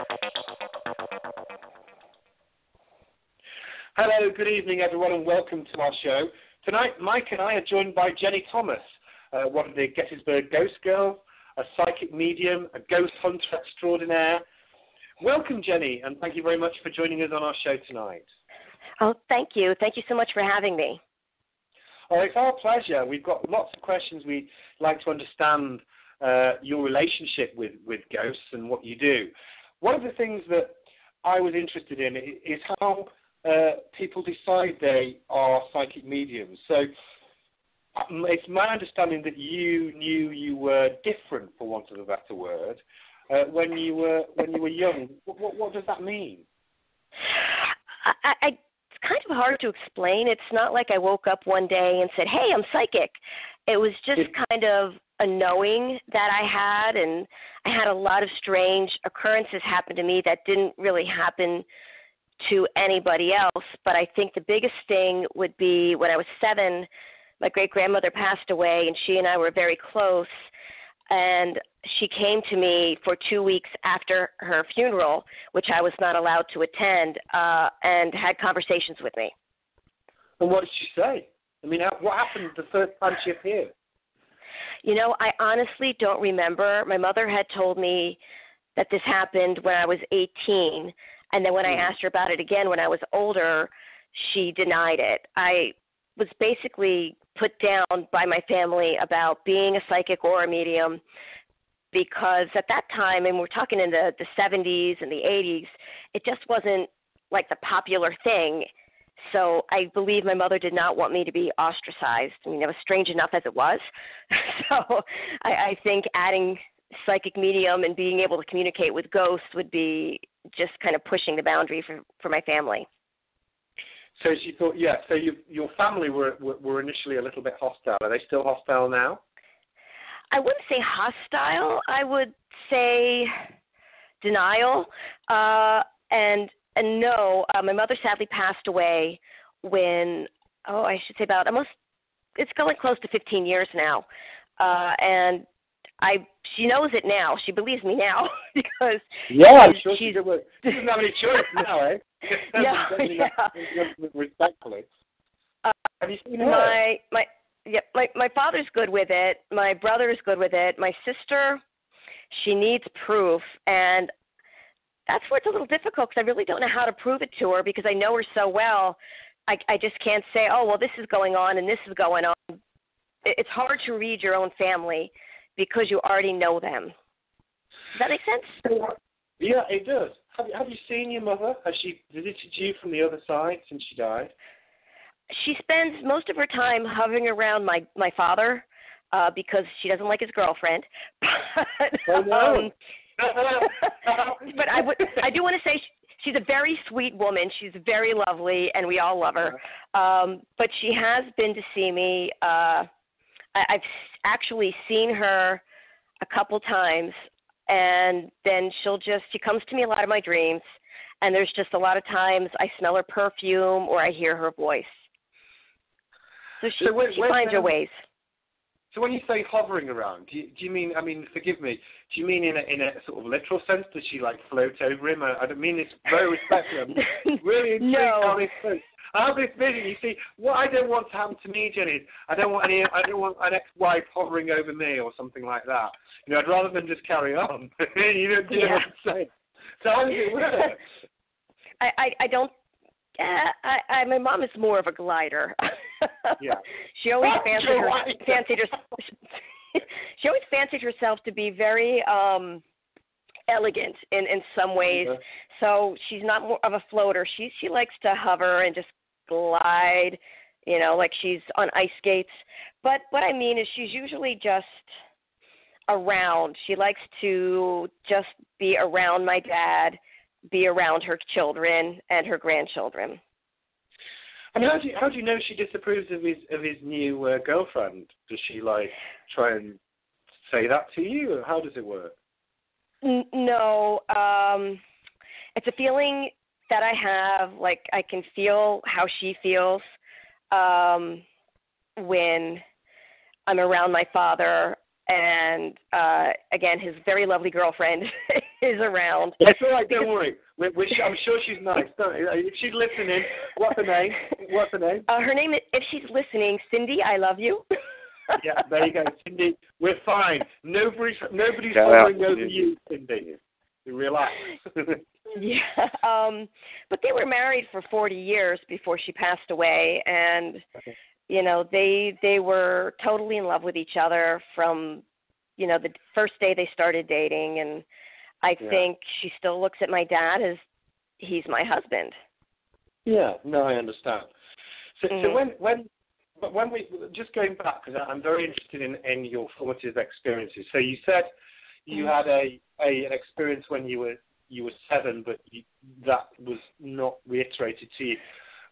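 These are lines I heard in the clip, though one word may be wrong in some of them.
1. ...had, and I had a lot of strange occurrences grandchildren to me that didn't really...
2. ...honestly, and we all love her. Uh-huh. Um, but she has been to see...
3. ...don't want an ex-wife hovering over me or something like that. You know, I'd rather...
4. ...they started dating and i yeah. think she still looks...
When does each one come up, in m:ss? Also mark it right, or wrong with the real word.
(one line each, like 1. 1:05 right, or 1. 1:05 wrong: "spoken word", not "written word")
1. 0:56 wrong: "happen", not "grandchildren"
2. 3:18 wrong: "lovely", not "honestly"
3. 3:53 right
4. 5:26 right.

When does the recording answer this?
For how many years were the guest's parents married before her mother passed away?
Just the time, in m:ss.
5:17.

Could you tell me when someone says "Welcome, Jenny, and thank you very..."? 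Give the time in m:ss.
0:15.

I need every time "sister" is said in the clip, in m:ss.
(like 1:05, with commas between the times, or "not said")
2:41.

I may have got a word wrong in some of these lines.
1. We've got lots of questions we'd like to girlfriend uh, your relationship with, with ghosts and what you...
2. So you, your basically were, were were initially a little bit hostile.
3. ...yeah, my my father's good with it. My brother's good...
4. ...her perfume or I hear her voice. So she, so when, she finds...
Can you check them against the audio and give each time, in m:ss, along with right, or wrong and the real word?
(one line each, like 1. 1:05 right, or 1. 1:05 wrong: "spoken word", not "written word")
1. 0:23 wrong: "understand", not "girlfriend"
2. 2:05 wrong: "family", not "basically"
3. 2:37 right
4. 3:32 right.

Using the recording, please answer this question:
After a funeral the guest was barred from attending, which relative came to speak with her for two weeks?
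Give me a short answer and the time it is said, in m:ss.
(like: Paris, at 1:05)
Great grandmother, at 1:07.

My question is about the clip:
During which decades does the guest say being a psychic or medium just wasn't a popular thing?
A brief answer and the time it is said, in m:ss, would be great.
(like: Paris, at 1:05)
The 70s and 80s, at 1:44.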